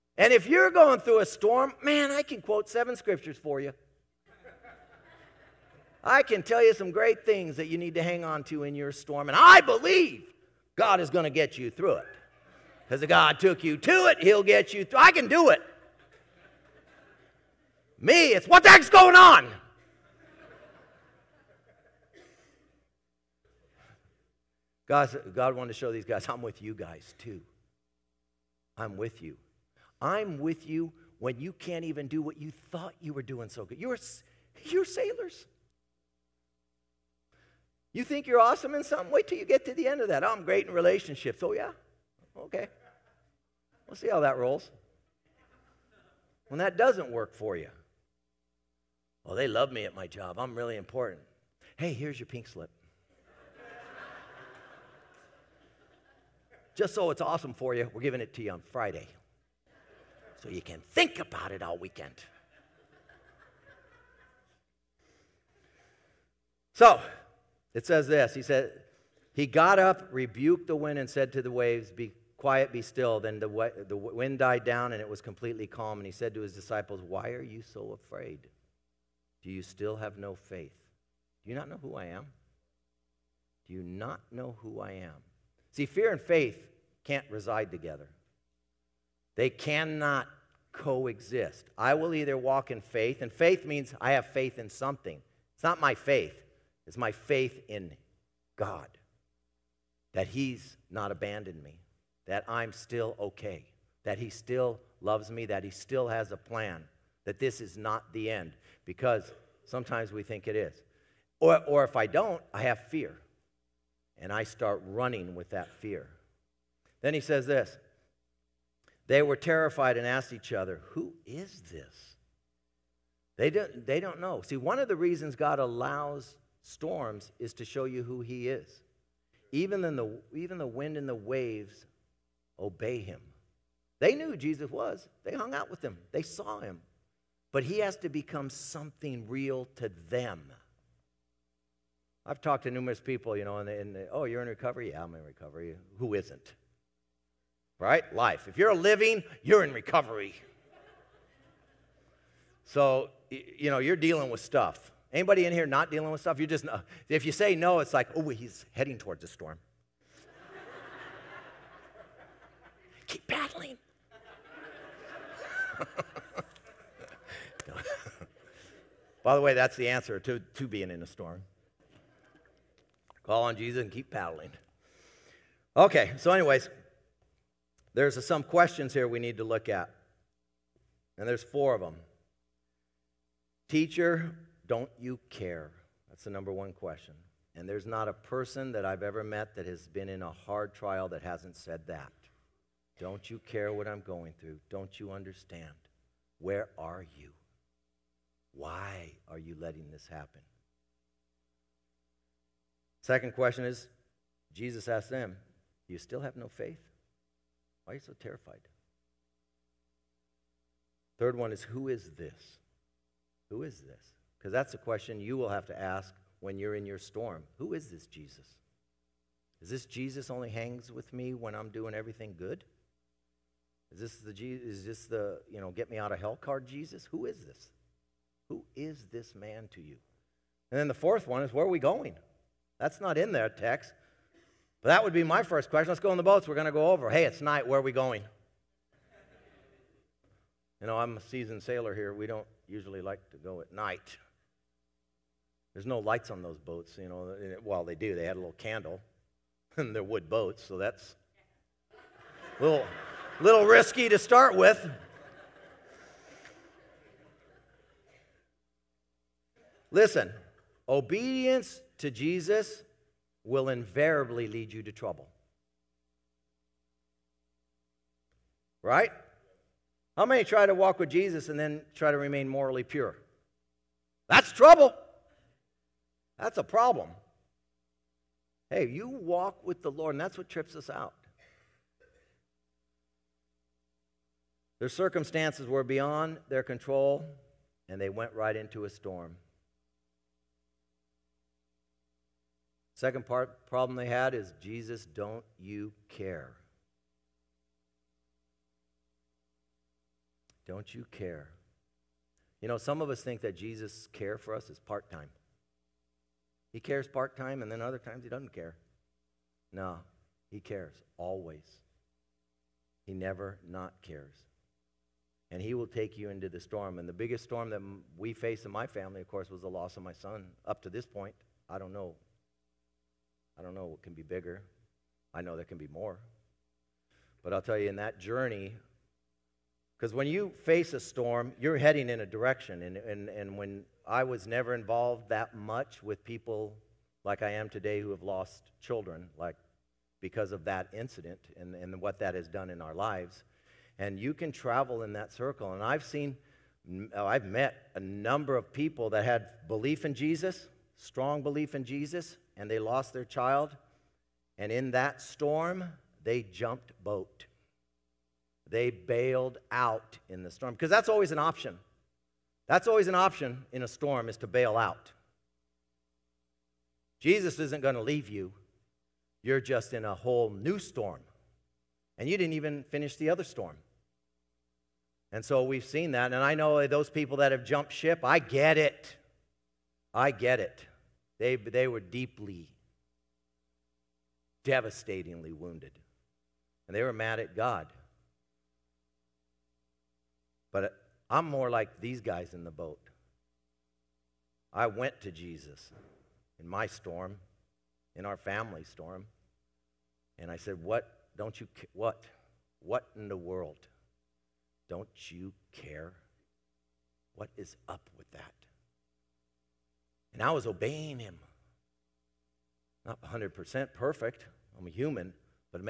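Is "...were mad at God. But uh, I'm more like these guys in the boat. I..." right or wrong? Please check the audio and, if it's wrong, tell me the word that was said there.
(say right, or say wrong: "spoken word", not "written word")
right.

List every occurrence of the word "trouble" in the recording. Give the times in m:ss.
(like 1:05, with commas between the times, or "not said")
4:24, 4:34.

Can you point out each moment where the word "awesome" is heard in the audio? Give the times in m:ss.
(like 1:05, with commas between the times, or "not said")
0:38, 0:57.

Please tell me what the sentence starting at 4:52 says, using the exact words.
Second part, problem they had is Jesus, don't you care?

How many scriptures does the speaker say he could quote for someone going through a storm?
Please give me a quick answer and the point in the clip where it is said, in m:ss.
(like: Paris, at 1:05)
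7, at 0:02.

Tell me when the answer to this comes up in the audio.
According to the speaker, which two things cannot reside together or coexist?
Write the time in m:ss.
1:25.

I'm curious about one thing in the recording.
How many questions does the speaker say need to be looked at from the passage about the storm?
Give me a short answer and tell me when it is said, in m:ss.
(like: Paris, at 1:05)
4, at 3:01.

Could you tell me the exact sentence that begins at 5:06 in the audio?
He cares part time, and then other times he doesn't care.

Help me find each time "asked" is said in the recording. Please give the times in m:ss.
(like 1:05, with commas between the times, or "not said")
2:00, 3:24.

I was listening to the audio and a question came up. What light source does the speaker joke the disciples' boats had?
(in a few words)
a little candle.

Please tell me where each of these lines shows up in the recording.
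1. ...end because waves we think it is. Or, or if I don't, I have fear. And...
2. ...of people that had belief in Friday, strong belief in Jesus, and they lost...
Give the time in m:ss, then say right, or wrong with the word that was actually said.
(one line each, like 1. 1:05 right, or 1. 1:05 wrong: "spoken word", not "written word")
1. 1:48 wrong: "sometimes", not "waves"
2. 5:48 wrong: "Jesus", not "Friday".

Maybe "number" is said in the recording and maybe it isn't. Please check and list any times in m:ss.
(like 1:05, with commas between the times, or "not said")
3:06, 5:47.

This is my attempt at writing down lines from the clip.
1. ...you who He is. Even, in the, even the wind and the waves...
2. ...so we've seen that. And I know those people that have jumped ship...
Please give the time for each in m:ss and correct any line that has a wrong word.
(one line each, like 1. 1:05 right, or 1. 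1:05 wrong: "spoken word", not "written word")
1. 2:07 right
2. 6:15 right.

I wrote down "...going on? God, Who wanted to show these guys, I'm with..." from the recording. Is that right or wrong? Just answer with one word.
wrong.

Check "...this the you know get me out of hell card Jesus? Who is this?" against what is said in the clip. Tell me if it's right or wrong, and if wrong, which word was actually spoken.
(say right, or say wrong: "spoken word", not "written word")
right.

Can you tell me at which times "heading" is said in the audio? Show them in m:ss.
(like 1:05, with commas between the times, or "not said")
2:38, 5:31.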